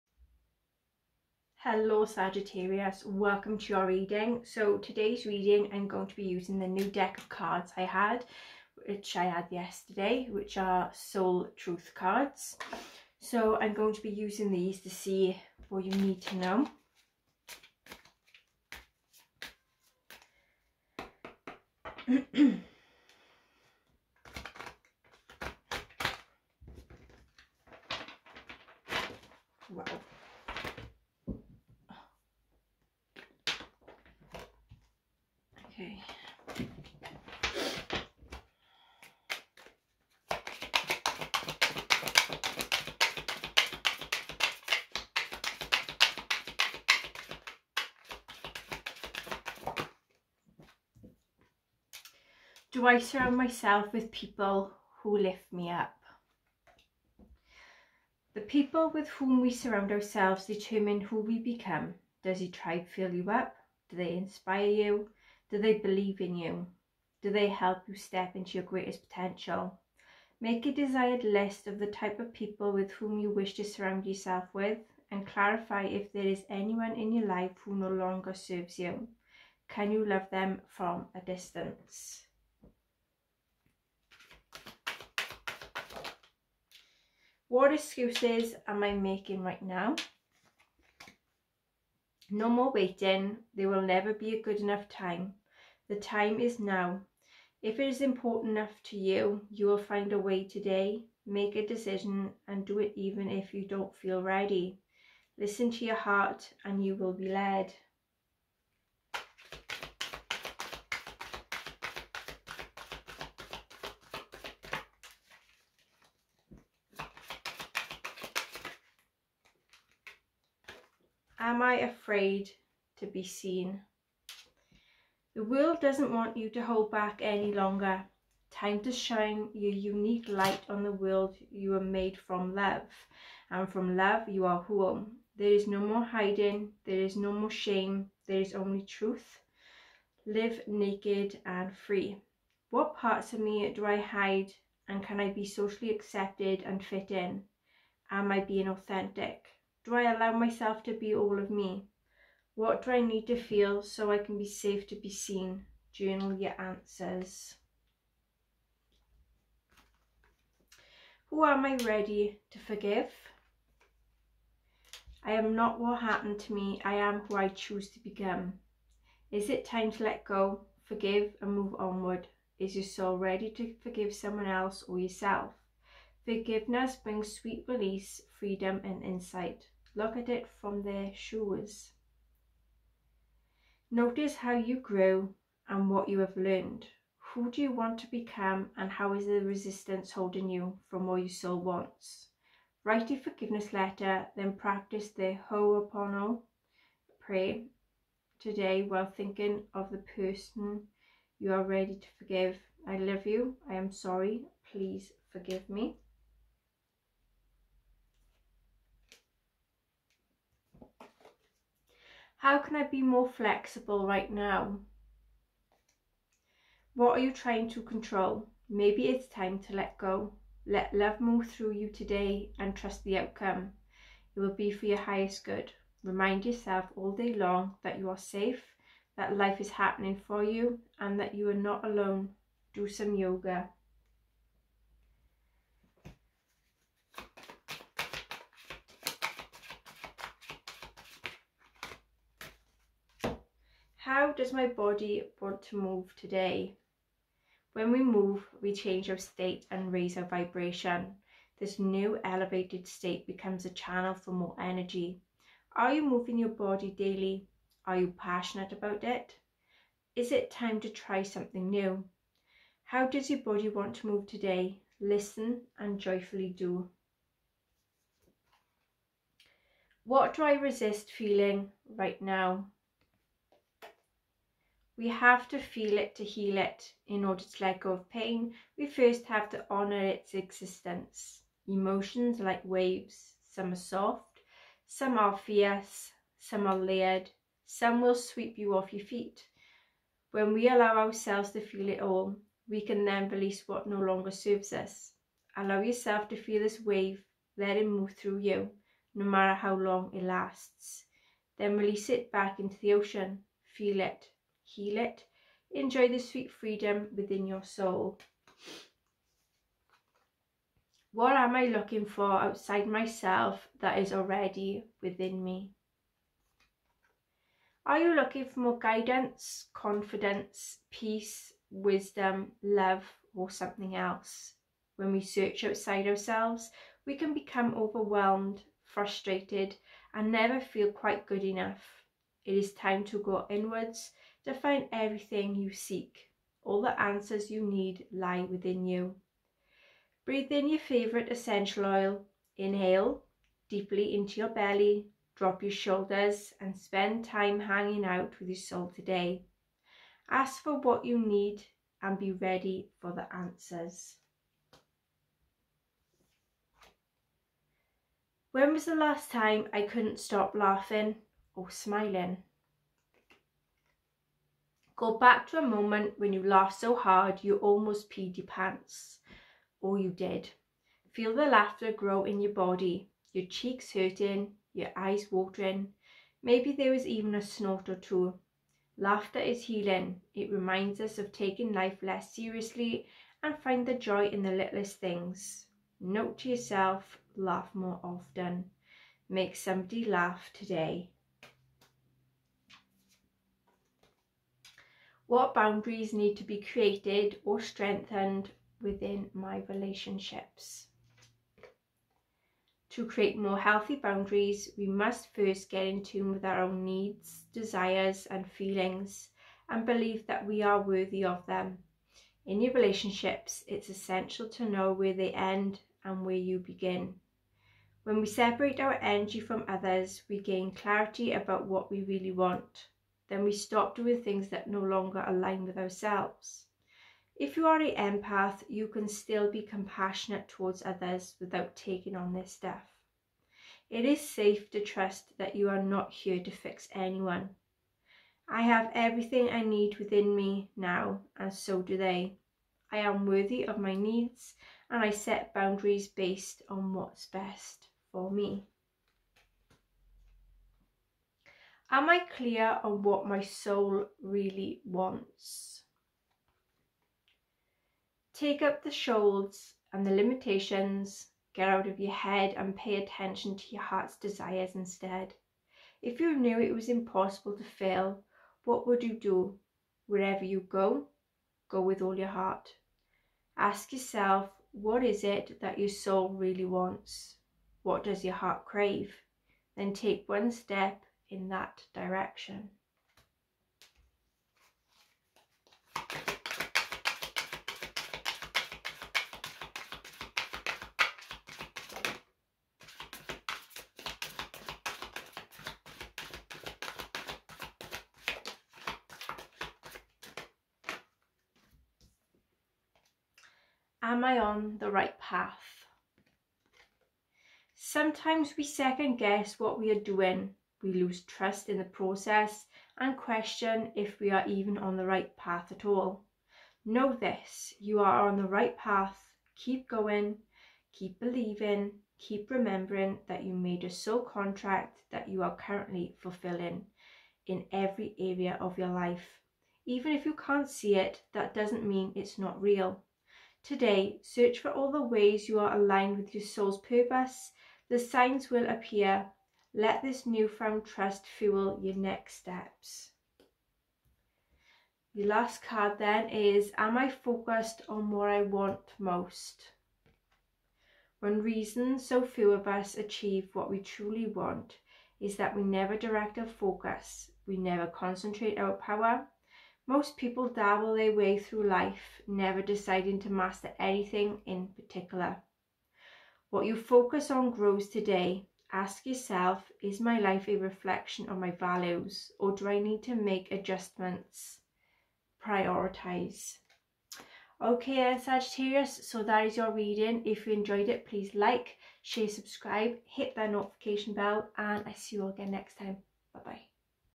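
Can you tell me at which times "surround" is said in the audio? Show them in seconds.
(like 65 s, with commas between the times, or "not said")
52 s, 59 s, 73 s.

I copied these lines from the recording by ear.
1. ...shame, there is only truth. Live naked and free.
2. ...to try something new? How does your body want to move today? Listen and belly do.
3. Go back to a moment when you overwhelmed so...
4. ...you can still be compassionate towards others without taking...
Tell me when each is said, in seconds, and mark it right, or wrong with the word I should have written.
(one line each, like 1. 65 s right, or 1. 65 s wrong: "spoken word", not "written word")
1. 137 s right
2. 260 s wrong: "joyfully", not "belly"
3. 365 s wrong: "laughed", not "overwhelmed"
4. 428 s right.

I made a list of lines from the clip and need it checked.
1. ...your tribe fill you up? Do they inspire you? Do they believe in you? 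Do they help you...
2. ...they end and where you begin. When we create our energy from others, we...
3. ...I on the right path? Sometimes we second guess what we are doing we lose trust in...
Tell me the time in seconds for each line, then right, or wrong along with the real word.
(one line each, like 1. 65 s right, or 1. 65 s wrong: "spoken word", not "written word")
1. 62 s right
2. 415 s wrong: "separate", not "create"
3. 504 s right.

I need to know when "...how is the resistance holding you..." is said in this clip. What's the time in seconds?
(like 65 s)
188 s.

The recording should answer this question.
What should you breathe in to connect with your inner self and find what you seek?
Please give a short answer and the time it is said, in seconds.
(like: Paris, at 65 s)
Your favourite essential oil, at 340 s.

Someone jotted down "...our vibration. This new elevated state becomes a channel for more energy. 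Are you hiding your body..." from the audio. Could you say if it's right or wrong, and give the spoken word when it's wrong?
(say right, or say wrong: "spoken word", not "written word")
wrong: "moving", not "hiding".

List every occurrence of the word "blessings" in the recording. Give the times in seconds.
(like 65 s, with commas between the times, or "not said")
not said.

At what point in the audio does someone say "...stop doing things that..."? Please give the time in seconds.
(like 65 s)
423 s.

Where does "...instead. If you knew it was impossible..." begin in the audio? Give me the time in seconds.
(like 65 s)
464 s.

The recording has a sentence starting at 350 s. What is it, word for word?
Ask for what you need and be ready for the answers.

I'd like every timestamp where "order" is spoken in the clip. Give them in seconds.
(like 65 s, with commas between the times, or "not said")
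277 s.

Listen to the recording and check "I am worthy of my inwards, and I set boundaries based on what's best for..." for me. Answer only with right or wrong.
wrong.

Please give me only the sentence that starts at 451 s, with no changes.
Am I clear on what my soul really wants?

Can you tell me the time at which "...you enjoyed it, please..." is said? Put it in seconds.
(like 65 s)
580 s.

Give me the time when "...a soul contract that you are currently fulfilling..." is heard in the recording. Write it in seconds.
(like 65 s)
523 s.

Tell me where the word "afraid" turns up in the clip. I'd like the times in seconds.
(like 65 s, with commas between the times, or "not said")
121 s.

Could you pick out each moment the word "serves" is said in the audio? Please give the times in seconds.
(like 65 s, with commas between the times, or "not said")
78 s, 294 s.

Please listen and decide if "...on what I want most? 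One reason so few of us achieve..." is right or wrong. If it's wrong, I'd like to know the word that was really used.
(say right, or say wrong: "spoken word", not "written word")
right.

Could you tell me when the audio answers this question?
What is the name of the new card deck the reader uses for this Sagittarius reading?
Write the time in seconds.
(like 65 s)
10 s.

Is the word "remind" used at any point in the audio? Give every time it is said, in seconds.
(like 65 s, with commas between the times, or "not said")
226 s, 380 s.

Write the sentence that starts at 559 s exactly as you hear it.
Most people dabble their way through life, never deciding to master anything in particular.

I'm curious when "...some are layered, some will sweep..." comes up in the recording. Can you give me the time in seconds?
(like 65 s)
286 s.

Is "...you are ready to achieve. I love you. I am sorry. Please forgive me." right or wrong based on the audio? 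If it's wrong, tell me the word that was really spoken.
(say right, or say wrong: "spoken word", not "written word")
wrong: "forgive", not "achieve".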